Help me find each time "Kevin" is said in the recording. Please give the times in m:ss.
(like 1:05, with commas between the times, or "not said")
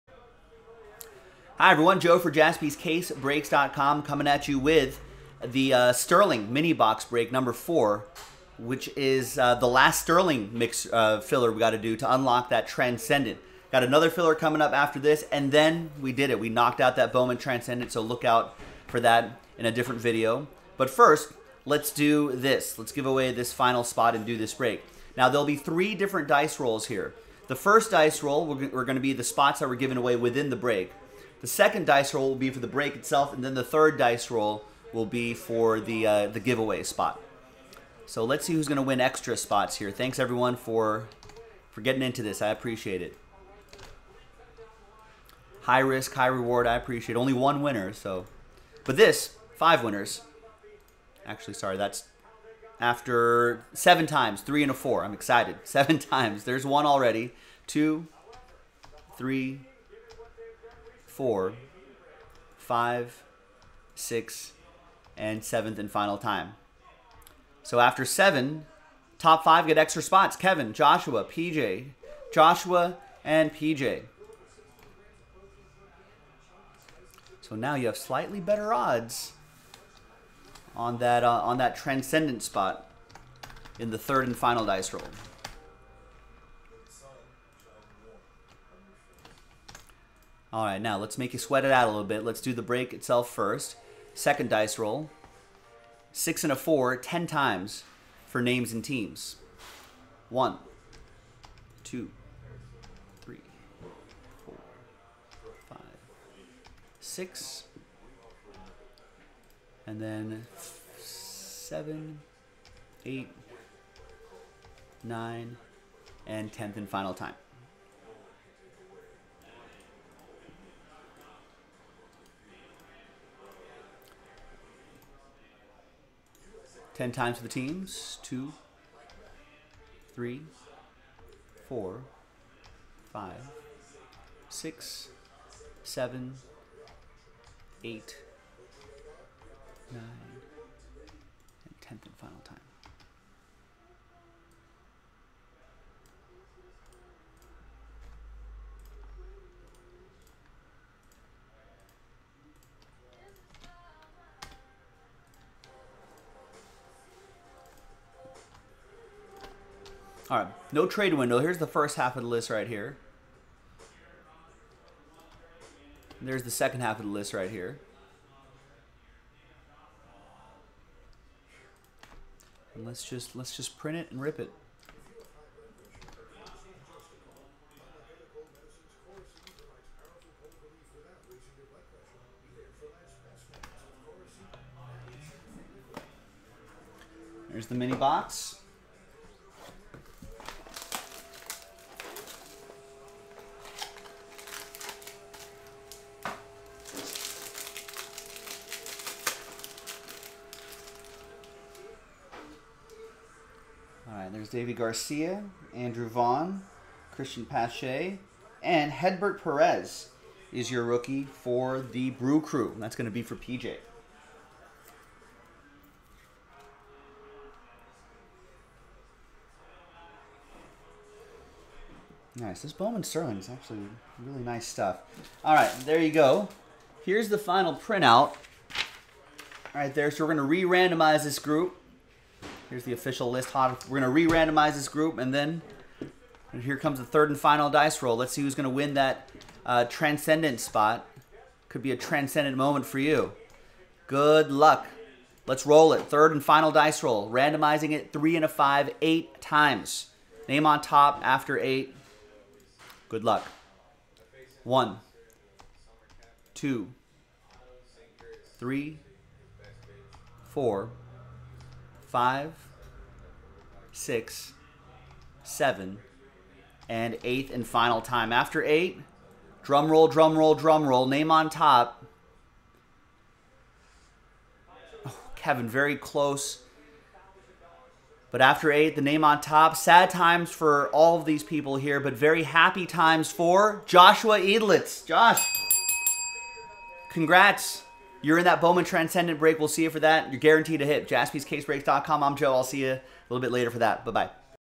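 1:10, 4:35.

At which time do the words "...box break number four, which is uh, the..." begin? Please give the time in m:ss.
0:06.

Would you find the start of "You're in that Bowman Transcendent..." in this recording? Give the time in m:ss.
4:48.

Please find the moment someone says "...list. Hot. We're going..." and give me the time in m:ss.
3:53.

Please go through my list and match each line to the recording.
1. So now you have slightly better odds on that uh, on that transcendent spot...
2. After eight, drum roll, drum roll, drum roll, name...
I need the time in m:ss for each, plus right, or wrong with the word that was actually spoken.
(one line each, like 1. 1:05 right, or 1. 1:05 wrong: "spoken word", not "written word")
1. 1:17 right
2. 4:28 right.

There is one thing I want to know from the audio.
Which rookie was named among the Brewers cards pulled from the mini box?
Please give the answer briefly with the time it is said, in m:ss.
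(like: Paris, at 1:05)
Hedbert Perez, at 3:28.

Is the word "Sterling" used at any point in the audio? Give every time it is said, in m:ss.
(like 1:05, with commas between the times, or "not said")
0:05, 0:10, 3:43.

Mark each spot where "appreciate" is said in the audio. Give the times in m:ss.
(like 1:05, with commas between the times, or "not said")
0:42, 0:46.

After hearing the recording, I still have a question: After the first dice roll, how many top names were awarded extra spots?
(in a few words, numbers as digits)
5.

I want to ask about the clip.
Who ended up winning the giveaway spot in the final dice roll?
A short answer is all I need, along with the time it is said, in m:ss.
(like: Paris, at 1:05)
Joshua Edlitz, at 4:43.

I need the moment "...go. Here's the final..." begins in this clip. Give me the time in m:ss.
3:46.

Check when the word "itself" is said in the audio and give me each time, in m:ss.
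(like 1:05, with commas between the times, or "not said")
0:32, 1:32.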